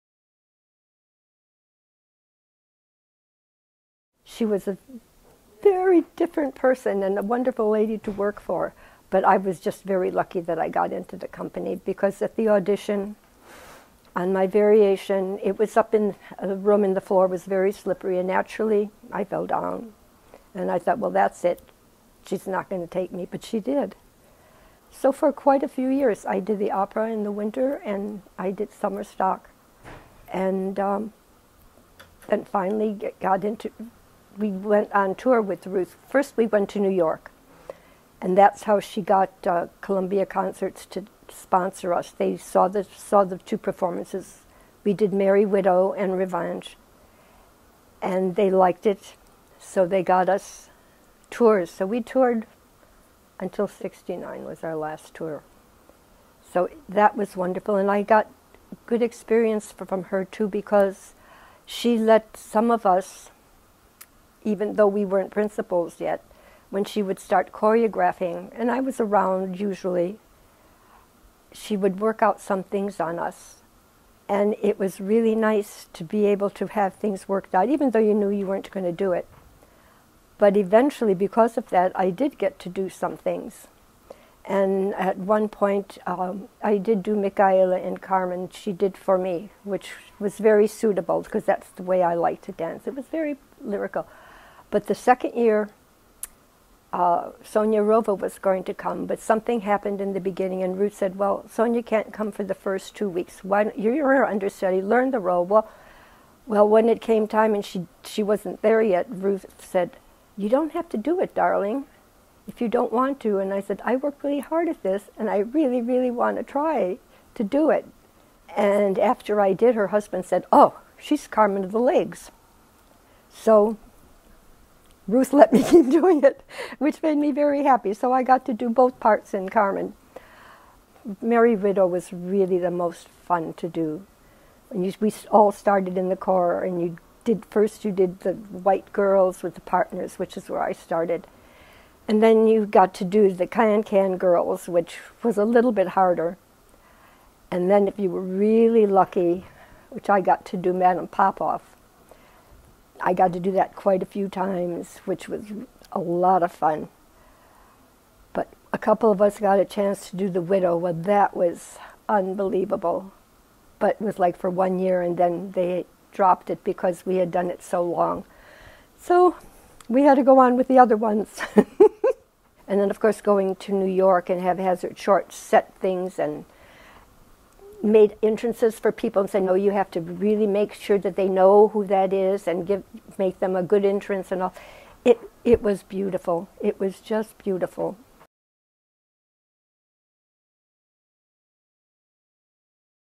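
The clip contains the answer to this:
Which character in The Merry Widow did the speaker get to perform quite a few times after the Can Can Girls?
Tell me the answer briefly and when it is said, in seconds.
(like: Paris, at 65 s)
Madame Popoff, at 150 s.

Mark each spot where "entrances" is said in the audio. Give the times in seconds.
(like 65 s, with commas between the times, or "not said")
178 s, 183 s.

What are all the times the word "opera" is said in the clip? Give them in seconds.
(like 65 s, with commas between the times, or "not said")
26 s.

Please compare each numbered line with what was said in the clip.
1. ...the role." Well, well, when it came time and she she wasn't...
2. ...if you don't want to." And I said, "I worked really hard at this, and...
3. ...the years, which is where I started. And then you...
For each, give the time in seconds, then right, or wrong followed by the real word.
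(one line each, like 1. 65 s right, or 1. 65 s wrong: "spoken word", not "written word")
1. 105 s right
2. 112 s right
3. 139 s wrong: "partners", not "years".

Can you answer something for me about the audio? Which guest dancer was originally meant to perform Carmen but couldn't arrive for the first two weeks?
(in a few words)
Sonia Arova.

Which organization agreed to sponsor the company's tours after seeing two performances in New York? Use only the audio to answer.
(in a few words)
Columbia Concerts.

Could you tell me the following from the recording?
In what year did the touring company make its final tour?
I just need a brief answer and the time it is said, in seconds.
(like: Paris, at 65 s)
1969, at 53 s.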